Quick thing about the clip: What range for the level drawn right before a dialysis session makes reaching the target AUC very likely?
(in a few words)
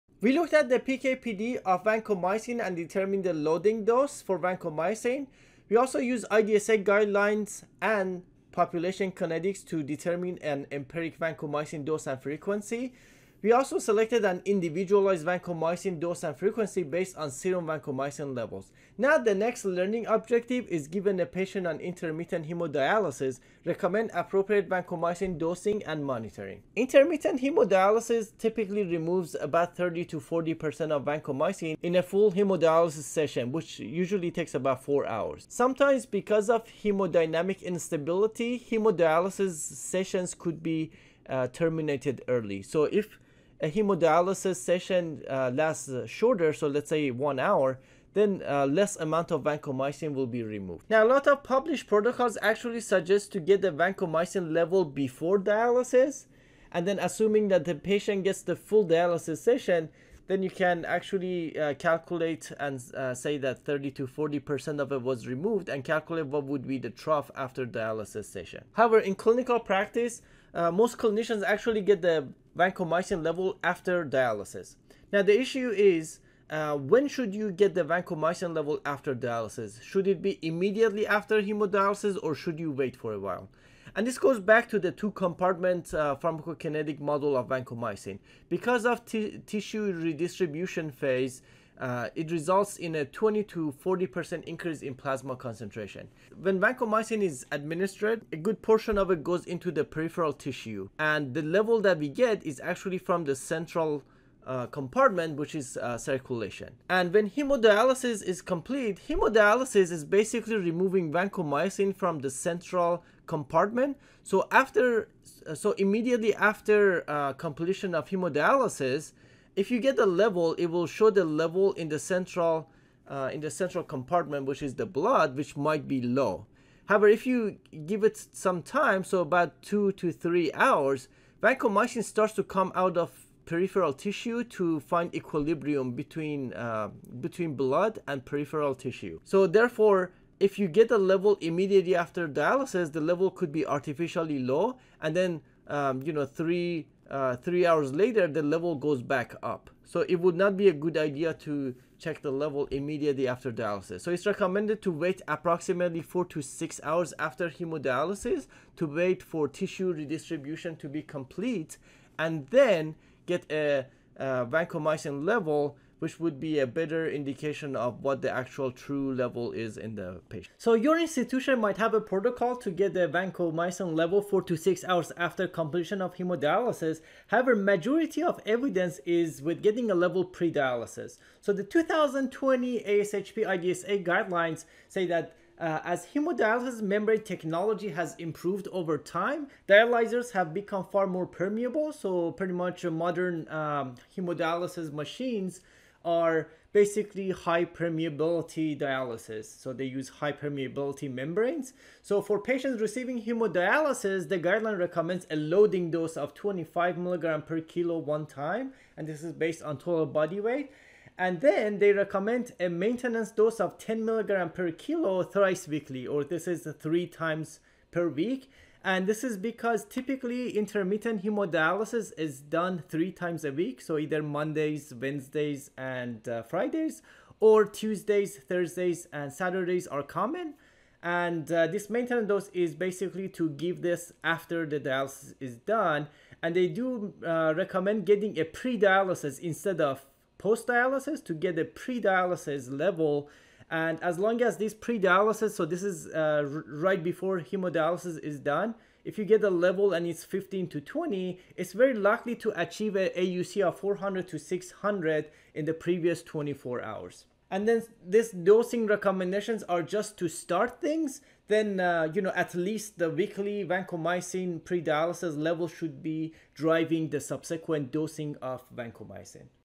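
15 to 20.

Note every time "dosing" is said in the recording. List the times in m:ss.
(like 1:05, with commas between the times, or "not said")
0:25, 4:18, 4:27.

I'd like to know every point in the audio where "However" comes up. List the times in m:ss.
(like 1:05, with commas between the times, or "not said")
1:08, 2:06, 2:57.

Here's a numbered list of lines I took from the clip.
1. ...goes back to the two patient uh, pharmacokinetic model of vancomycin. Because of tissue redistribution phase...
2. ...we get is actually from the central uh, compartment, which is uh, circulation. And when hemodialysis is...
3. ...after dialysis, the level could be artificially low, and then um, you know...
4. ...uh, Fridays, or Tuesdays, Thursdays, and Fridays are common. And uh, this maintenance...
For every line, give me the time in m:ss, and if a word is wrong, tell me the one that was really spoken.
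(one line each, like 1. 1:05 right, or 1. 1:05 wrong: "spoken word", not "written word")
1. 1:24 wrong: "compartment", not "patient"
2. 1:41 right
3. 2:21 right
4. 3:46 wrong: "Saturdays", not "Fridays".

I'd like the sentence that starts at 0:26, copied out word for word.
Intermittent hemodialysis typically removes about 30 to 40% of vancomycin in a full hemodialysis session, which usually takes about 4 hours.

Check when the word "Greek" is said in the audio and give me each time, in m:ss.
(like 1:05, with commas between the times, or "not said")
not said.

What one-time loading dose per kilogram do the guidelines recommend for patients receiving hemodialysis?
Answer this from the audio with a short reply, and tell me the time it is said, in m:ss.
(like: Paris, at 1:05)
25 mg/kg, at 3:26.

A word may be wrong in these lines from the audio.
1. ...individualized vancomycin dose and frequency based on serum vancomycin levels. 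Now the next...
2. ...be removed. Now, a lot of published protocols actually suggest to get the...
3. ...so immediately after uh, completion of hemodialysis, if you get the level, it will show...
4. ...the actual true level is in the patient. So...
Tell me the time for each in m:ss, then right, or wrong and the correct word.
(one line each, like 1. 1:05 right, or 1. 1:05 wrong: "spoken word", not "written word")
1. 0:14 right
2. 0:50 right
3. 1:55 right
4. 2:48 right.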